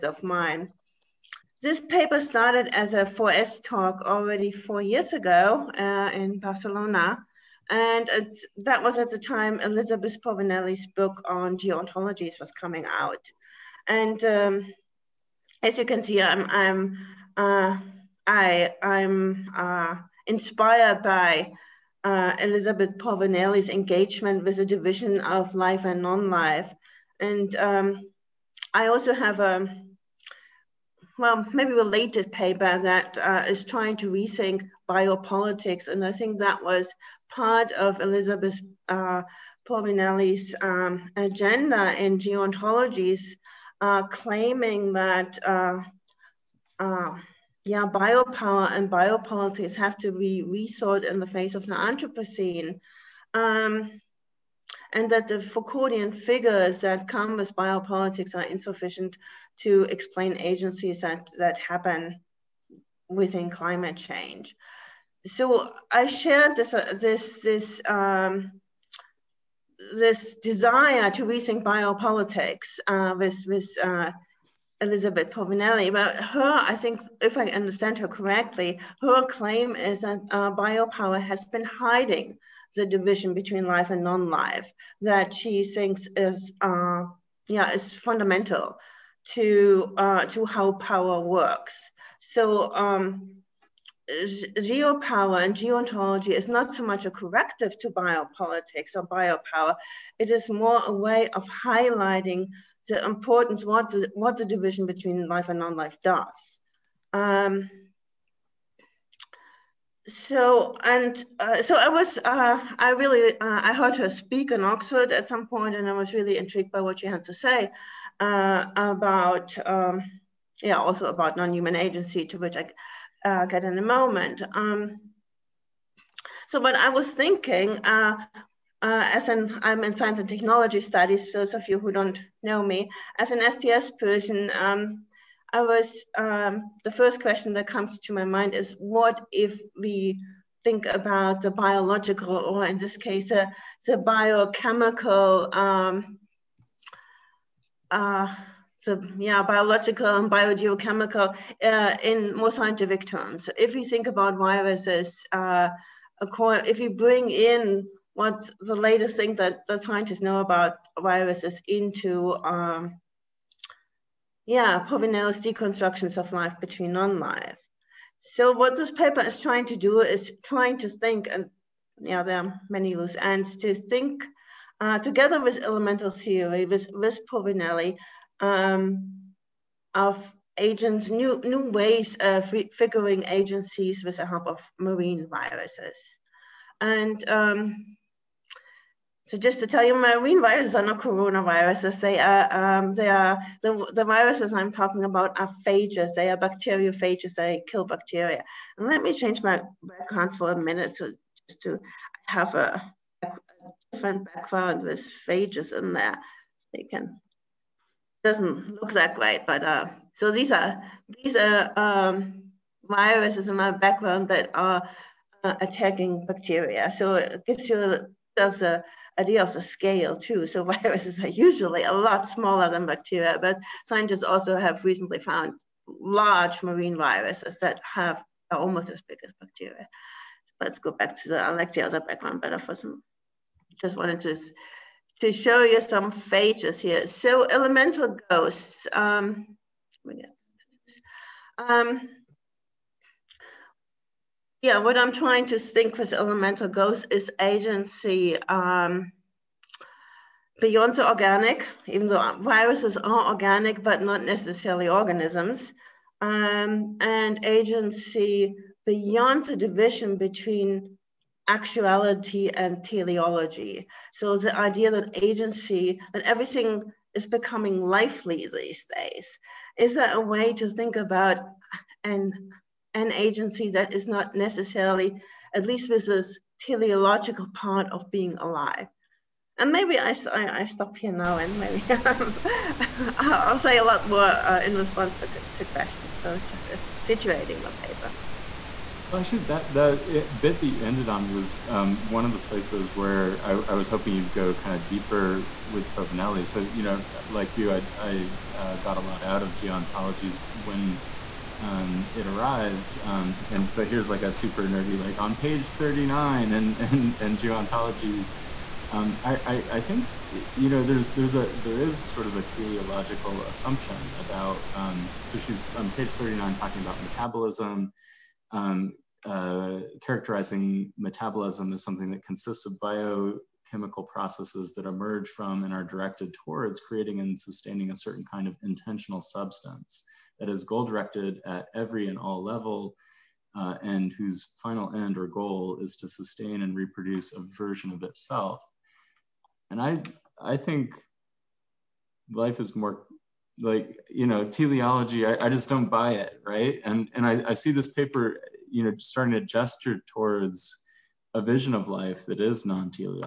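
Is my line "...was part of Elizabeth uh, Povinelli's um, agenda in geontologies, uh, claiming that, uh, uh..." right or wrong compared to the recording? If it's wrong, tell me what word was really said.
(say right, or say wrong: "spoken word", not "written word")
right.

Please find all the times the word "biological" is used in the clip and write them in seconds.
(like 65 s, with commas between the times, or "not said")
141 s, 149 s.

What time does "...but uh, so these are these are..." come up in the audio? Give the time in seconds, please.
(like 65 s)
209 s.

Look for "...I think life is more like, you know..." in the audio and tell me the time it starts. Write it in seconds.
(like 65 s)
340 s.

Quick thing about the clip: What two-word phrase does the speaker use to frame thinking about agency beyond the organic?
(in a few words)
Elemental Ghost.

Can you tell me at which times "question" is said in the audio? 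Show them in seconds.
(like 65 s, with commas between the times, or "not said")
137 s, 285 s.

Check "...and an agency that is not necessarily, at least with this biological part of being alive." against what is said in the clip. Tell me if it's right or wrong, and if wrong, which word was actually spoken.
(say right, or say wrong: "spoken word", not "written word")
wrong: "teleological", not "biological".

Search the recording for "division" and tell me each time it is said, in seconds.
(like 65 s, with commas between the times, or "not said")
24 s, 82 s, 104 s, 259 s.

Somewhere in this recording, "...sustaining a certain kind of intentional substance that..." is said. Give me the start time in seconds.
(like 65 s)
327 s.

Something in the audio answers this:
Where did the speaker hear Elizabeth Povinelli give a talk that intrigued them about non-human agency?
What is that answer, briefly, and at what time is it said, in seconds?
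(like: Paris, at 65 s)
Oxford, at 114 s.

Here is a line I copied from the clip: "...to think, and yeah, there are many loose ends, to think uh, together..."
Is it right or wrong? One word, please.
right.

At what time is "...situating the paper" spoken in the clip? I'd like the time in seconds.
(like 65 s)
287 s.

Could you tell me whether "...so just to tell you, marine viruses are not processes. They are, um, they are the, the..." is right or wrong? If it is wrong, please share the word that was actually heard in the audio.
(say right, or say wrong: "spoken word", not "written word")
wrong: "coronaviruses", not "processes".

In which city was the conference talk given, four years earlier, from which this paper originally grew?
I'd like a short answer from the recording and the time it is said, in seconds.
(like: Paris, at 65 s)
Barcelona, at 6 s.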